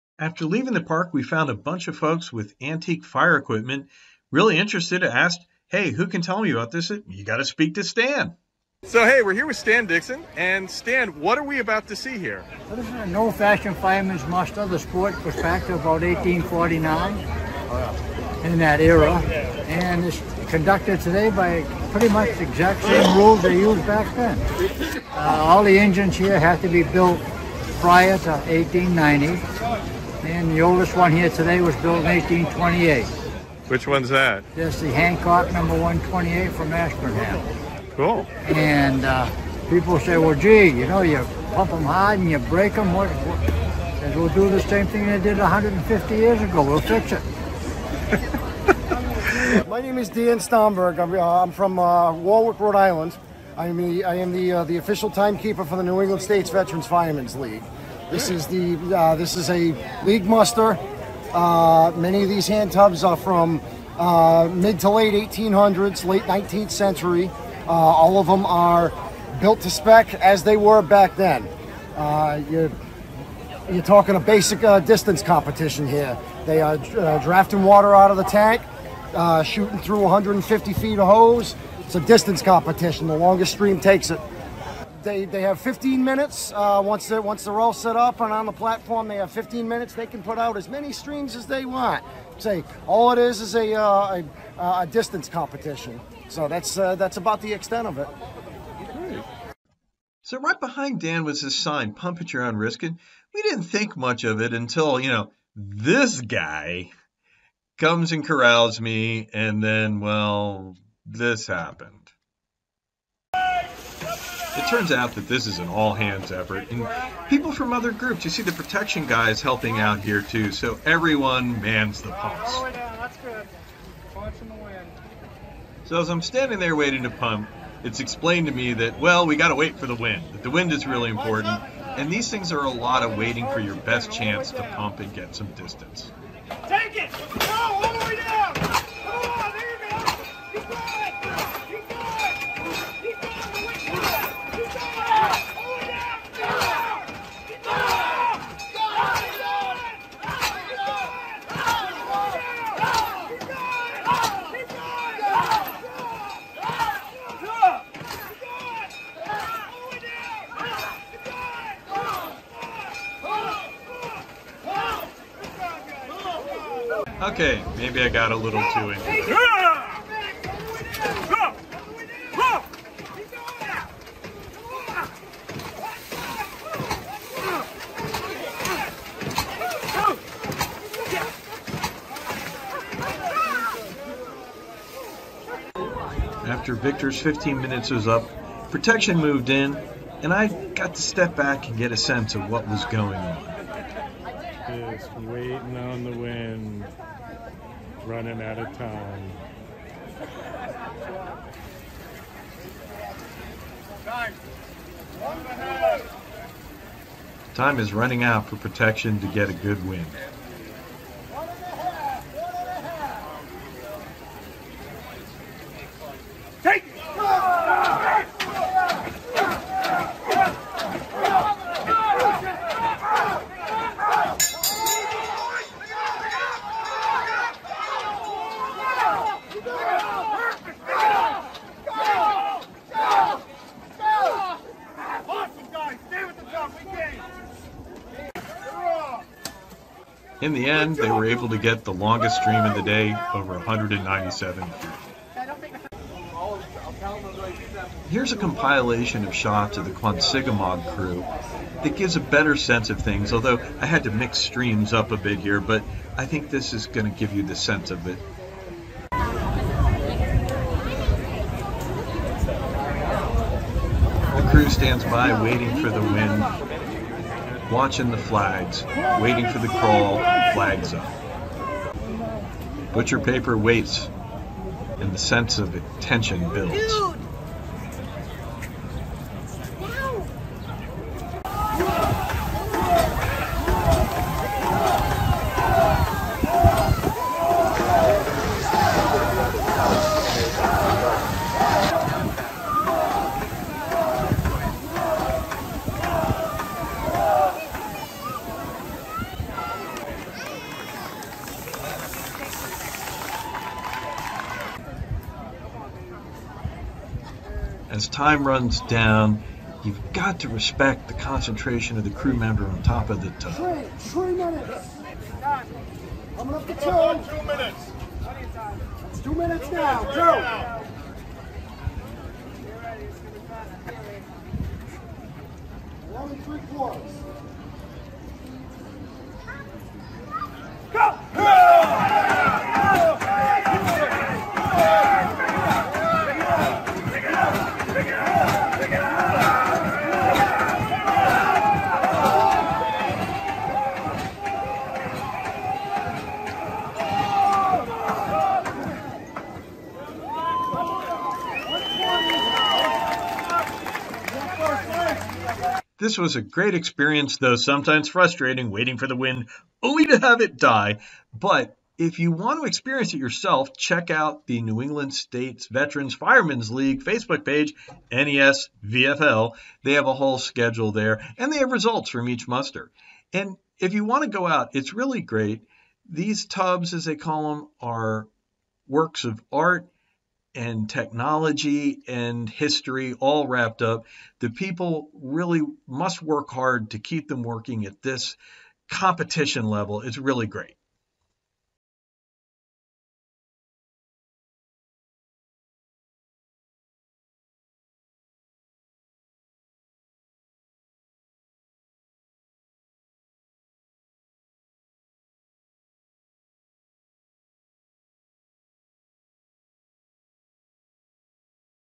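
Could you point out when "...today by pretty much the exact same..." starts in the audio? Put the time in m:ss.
0:21.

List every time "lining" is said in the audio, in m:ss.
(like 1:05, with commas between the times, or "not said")
not said.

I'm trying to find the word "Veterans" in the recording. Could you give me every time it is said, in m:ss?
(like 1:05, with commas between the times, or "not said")
0:56, 6:05.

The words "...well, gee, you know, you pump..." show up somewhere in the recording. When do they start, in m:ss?
0:40.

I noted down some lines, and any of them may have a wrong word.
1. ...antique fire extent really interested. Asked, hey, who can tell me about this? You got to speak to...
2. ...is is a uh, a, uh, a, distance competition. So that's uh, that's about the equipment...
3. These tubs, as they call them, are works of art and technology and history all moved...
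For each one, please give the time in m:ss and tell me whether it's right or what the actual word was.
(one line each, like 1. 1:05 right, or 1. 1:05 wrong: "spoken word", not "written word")
1. 0:02 wrong: "equipment", not "extent"
2. 1:33 wrong: "extent", not "equipment"
3. 6:16 wrong: "wrapped", not "moved".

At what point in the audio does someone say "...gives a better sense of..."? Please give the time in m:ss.
4:11.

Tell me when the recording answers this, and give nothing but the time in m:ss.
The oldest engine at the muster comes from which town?
0:36.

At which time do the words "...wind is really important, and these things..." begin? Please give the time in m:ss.
2:10.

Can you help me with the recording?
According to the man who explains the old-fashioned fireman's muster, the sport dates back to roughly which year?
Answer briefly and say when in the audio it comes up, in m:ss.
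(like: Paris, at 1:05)
1849, at 0:16.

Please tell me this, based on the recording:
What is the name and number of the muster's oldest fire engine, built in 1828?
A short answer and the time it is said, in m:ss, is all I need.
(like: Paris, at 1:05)
Hancock number 128, at 0:34.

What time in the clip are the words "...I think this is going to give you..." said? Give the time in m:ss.
4:16.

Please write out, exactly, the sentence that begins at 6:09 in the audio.
They have a whole schedule there and they have results from each muster.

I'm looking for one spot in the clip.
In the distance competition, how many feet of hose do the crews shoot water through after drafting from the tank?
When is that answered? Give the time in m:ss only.
1:20.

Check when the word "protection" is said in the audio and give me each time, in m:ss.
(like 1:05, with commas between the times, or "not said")
1:58, 3:08, 3:28.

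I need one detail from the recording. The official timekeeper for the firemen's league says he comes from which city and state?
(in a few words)
Warwick, Rhode Island.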